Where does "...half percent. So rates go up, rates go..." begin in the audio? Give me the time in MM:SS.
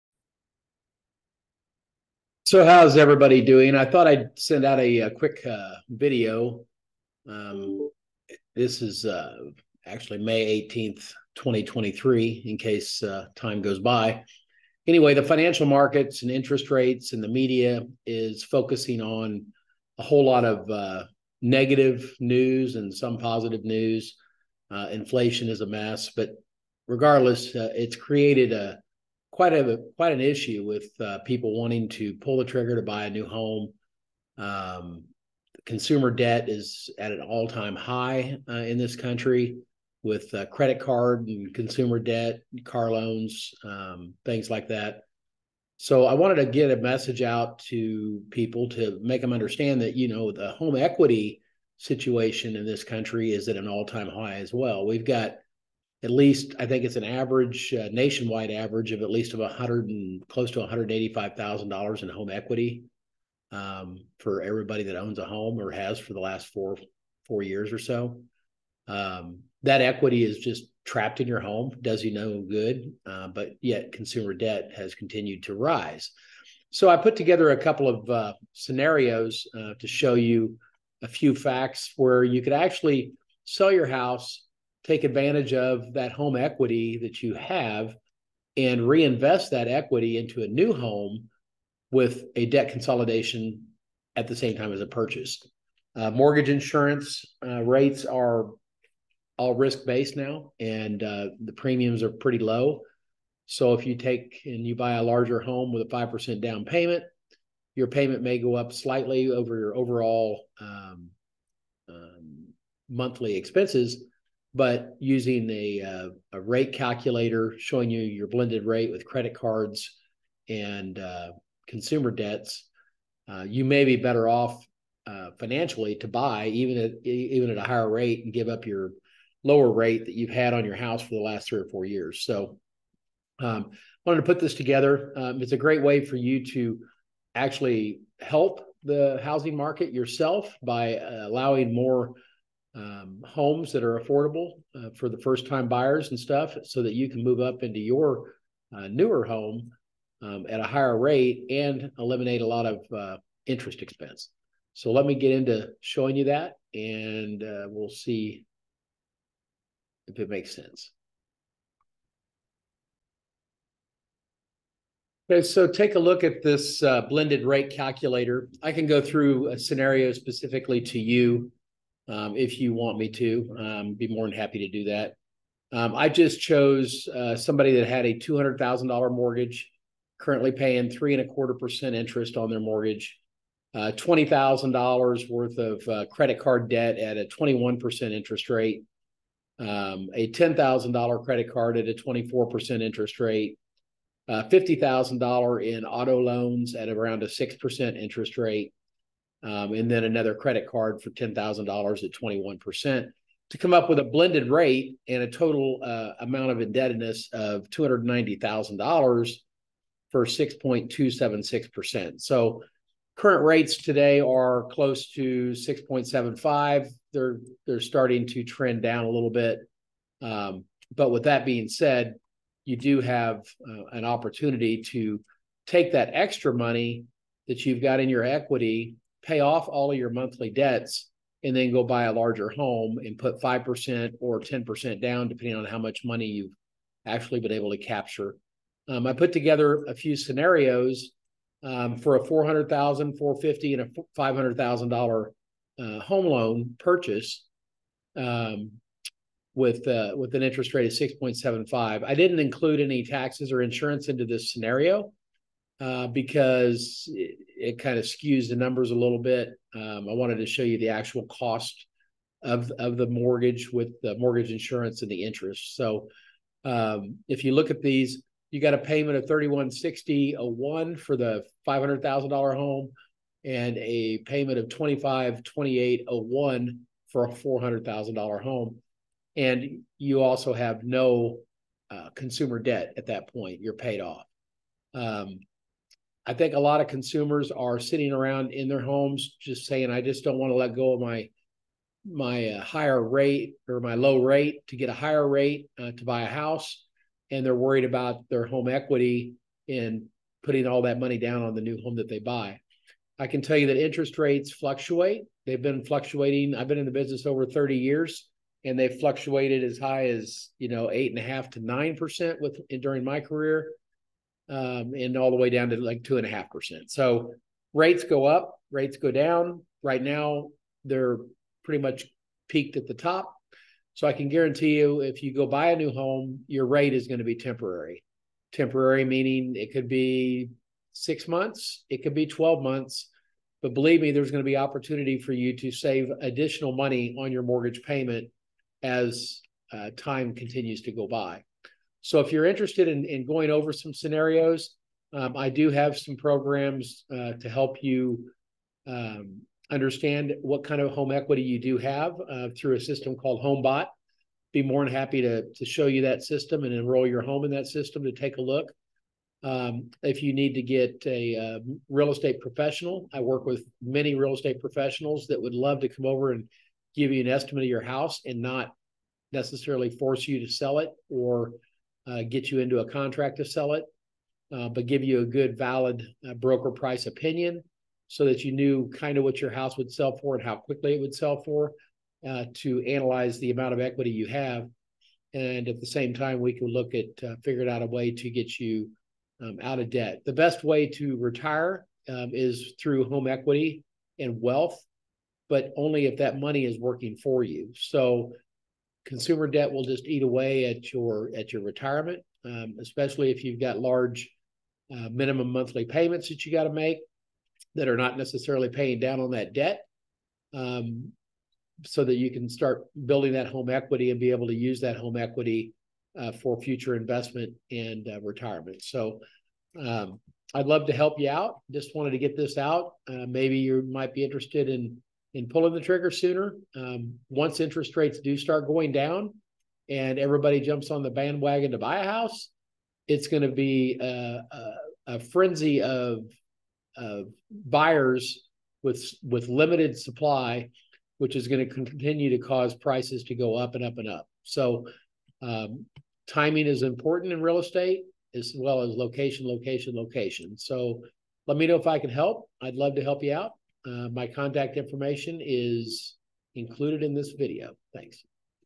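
05:16.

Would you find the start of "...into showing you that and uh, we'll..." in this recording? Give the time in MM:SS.
02:35.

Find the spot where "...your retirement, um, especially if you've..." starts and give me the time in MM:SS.
06:41.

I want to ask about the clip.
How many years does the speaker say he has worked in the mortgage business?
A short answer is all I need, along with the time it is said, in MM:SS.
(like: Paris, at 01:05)
Over 30 years, at 05:07.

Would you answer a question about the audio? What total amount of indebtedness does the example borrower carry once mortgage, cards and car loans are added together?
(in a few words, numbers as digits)
$290,000.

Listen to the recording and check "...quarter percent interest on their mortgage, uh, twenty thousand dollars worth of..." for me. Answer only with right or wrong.
right.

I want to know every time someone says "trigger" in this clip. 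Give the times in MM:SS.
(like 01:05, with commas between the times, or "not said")
00:32, 07:05.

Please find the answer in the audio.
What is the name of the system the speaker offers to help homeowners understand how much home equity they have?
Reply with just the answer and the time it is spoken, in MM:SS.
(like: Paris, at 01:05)
HomeBot, at 05:53.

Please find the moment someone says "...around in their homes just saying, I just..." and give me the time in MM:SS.
04:48.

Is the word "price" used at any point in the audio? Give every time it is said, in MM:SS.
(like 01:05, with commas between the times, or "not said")
06:16, 07:22.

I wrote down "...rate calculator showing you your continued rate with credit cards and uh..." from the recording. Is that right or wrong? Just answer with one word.
wrong.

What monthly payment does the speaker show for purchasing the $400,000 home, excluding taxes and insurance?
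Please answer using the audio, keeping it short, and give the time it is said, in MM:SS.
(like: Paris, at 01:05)
$2,528, at 04:34.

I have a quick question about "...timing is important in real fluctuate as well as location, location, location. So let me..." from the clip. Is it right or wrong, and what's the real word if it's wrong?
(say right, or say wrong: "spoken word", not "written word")
wrong: "estate", not "fluctuate".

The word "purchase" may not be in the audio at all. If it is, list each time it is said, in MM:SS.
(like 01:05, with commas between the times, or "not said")
01:34, 04:06.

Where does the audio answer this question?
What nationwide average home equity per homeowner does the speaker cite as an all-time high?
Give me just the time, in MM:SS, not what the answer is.
01:00.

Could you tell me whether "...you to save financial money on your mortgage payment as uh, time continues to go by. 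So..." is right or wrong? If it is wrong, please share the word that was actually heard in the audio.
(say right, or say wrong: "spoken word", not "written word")
wrong: "additional", not "financial".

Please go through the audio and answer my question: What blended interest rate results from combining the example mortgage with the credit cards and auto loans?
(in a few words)
6.276%.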